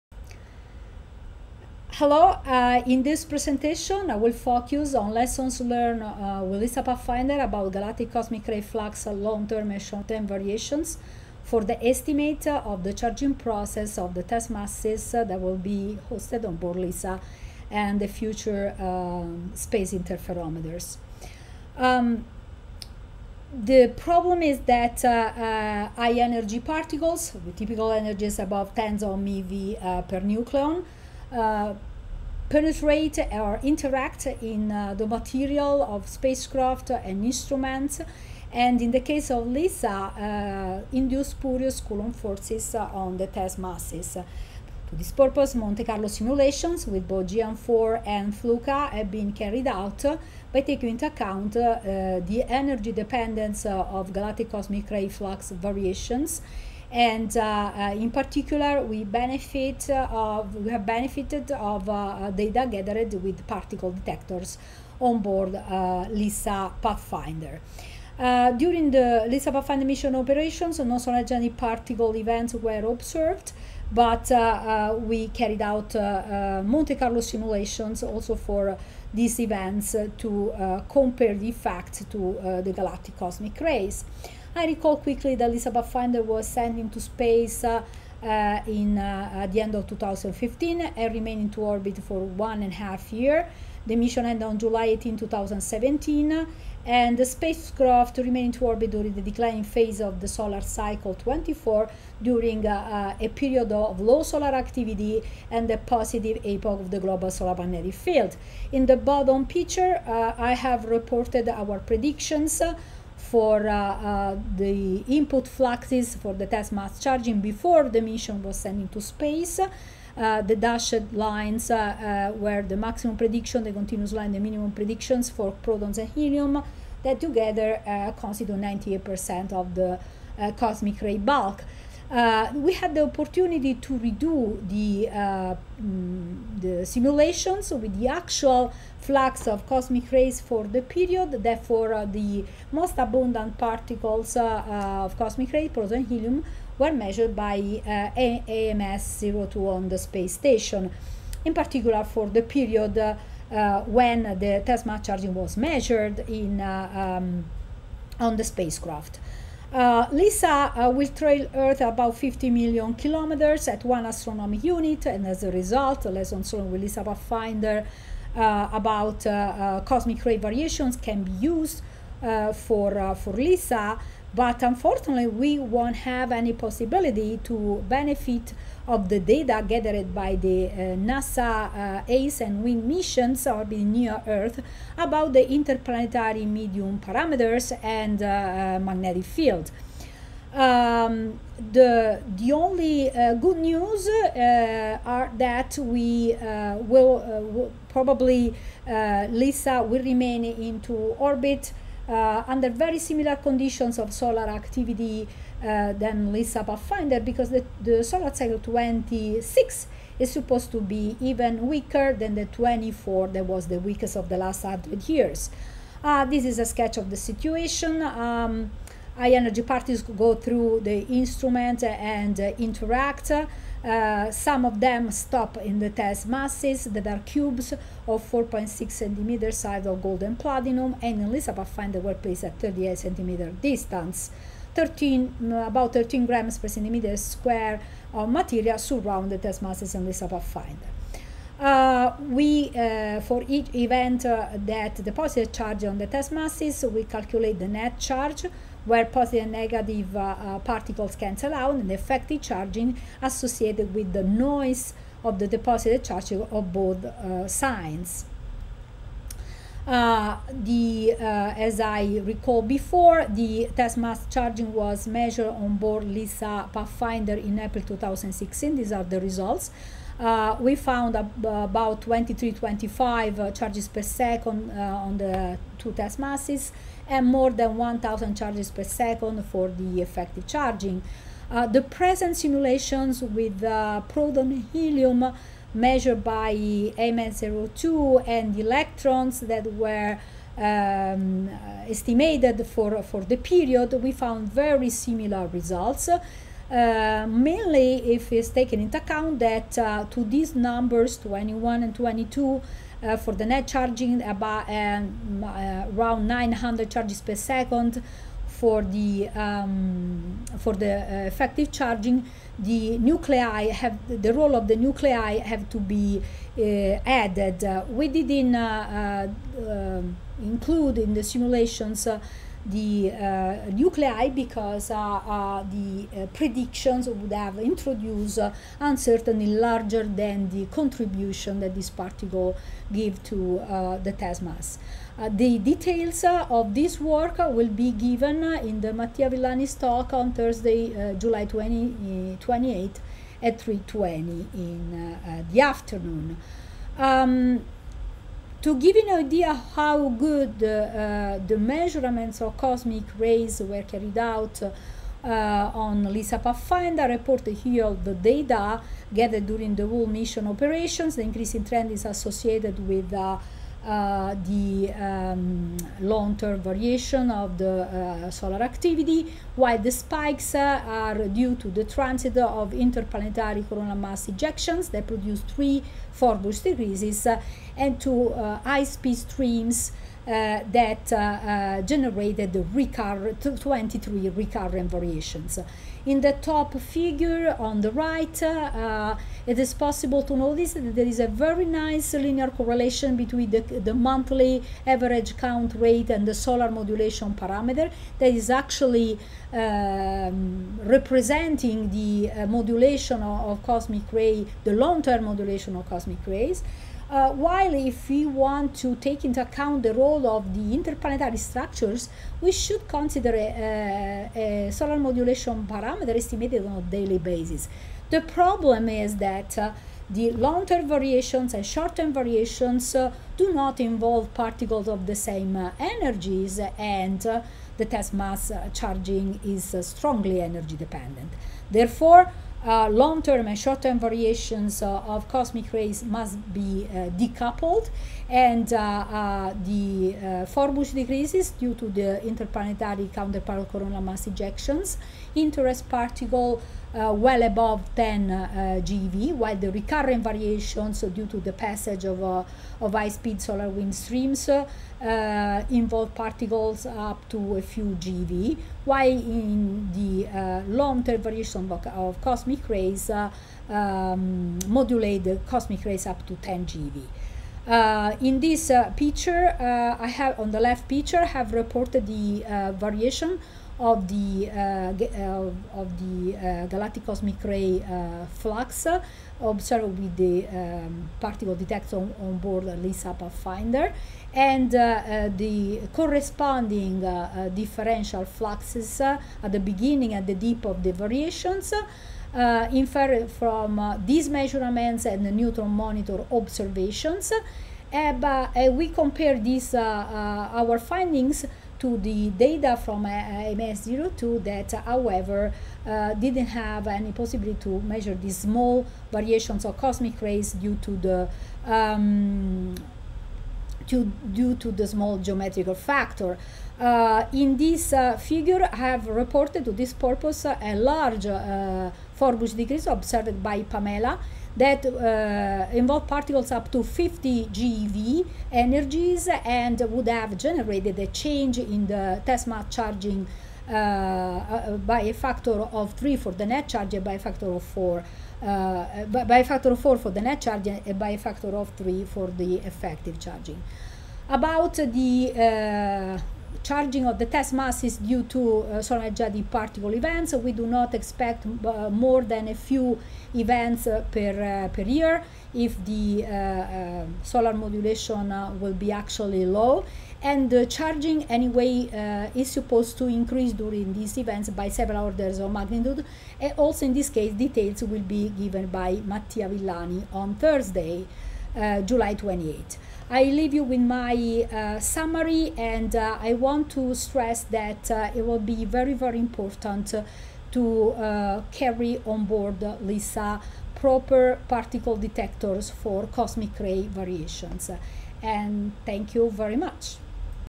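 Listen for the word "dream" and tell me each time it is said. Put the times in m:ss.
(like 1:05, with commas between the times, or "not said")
not said.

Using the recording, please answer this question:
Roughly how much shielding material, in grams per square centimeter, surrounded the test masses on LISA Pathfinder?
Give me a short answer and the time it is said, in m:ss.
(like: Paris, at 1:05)
13 grams per square centimeter, at 3:55.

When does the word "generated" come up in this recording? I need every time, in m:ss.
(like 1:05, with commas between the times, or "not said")
6:21, 8:50.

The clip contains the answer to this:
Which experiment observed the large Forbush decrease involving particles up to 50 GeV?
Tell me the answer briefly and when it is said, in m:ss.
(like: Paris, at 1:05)
PAMELA, at 8:43.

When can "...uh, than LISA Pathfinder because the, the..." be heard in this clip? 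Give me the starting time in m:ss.
3:25.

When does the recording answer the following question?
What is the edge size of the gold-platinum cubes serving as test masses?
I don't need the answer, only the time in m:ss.
3:48.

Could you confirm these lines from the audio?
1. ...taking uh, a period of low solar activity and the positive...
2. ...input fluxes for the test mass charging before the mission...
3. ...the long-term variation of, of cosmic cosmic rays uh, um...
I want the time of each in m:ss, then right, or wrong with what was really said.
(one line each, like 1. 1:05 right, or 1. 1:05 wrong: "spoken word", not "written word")
1. 1:42 wrong: "during", not "taking"
2. 1:55 right
3. 7:39 right.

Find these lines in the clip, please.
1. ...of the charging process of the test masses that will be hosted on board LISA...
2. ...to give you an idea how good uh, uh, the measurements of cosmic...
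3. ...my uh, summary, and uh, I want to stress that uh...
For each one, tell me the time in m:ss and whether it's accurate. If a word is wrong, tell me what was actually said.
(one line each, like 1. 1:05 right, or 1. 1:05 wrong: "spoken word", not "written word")
1. 0:12 right
2. 5:48 right
3. 9:33 right.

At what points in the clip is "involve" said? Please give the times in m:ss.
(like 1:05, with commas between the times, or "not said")
7:03, 7:35, 8:45.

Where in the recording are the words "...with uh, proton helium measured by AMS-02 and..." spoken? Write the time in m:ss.
4:43.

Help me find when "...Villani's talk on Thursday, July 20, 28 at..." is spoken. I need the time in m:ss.
5:39.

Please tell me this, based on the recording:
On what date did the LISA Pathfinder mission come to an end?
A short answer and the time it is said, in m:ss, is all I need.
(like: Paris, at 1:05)
July 18, 2017, at 1:34.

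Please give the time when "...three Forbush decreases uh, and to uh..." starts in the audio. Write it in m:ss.
6:15.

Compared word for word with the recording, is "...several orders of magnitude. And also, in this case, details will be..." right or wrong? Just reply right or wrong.
right.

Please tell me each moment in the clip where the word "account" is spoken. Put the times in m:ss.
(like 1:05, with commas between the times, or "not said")
0:51, 4:58, 6:49.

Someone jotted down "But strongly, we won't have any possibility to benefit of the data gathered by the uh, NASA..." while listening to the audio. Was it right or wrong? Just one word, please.
wrong.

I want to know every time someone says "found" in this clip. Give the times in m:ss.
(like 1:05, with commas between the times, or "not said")
4:30, 4:54.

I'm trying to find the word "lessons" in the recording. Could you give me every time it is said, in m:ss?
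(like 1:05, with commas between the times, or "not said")
0:05, 2:46.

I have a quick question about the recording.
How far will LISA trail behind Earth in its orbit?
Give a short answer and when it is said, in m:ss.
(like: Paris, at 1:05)
50 million kilometers, at 2:42.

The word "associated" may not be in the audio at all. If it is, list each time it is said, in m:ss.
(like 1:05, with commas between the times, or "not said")
4:13, 6:02.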